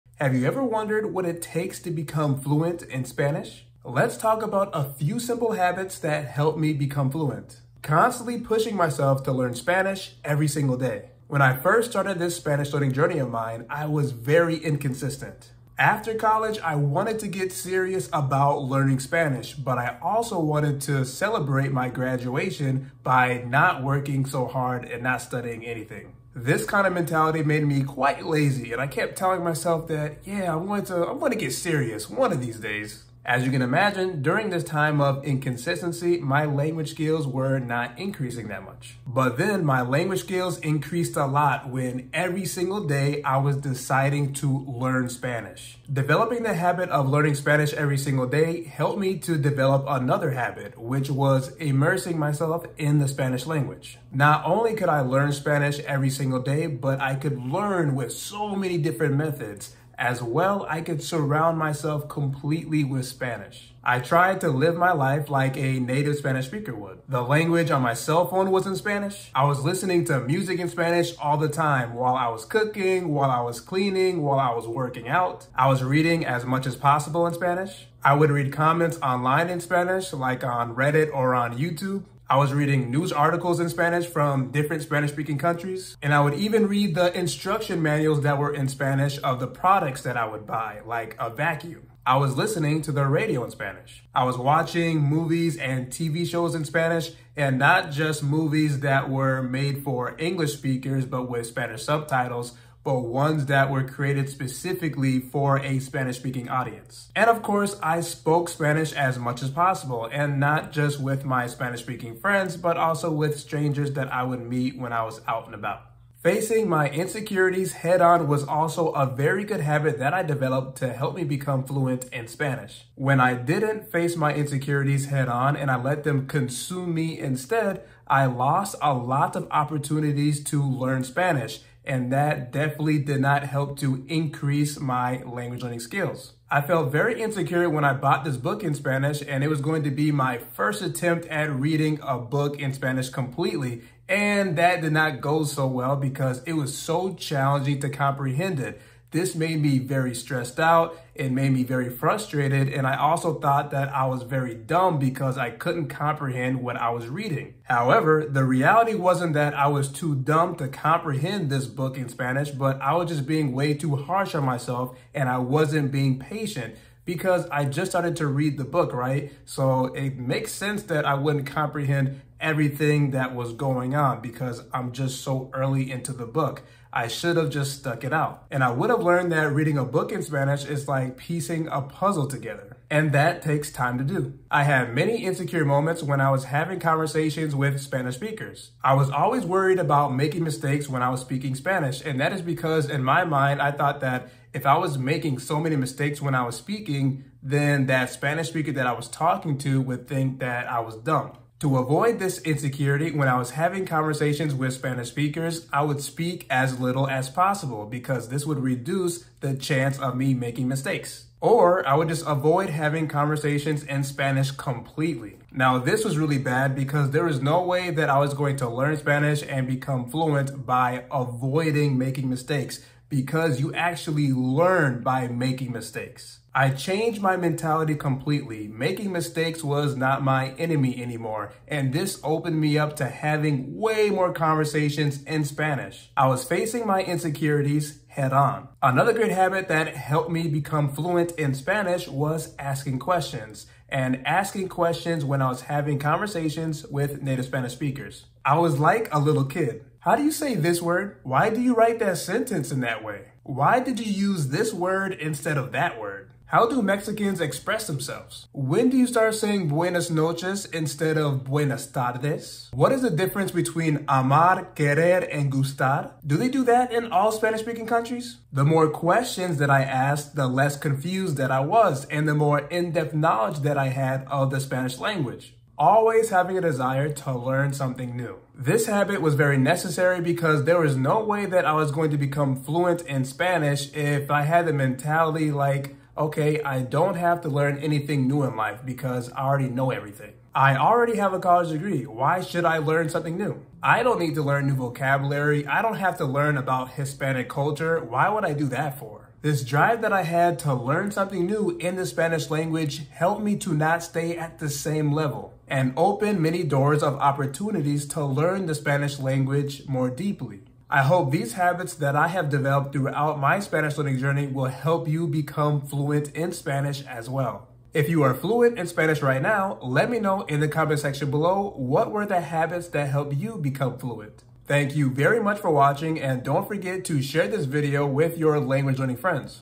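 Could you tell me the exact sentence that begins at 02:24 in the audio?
And that did not go so well because it was so challenging to comprehend it.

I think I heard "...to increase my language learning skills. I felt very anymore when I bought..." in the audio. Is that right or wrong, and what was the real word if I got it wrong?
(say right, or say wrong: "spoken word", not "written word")
wrong: "insecure", not "anymore".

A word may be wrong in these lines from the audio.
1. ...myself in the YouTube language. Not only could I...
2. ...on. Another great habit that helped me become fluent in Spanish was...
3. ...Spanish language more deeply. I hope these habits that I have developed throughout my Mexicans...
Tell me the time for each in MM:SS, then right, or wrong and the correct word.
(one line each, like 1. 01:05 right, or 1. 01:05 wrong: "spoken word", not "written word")
1. 00:52 wrong: "Spanish", not "YouTube"
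2. 03:58 right
3. 05:08 wrong: "Spanish", not "Mexicans".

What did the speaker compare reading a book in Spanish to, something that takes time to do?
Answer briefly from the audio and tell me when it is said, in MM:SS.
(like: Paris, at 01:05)
Piecing a puzzle together, at 03:01.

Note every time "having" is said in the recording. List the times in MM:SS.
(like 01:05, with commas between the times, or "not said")
03:06, 03:23, 03:32, 03:53, 04:05, 04:36.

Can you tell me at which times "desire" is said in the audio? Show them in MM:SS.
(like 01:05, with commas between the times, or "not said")
04:36.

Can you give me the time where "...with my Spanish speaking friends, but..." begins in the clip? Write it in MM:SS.
01:50.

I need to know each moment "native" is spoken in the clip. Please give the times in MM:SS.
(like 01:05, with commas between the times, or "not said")
01:05, 04:07.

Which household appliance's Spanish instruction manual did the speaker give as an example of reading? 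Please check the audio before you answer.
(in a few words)
A vacuum.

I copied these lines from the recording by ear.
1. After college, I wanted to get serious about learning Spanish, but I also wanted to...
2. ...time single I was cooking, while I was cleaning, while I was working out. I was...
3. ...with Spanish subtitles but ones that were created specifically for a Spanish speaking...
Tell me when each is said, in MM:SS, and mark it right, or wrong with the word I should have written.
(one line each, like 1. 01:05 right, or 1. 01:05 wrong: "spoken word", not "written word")
1. 00:15 right
2. 01:11 wrong: "while", not "single"
3. 01:41 right.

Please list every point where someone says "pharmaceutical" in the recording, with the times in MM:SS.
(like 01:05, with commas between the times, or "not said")
not said.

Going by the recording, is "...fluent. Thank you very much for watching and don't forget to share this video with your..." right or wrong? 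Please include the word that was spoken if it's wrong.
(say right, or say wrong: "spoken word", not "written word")
right.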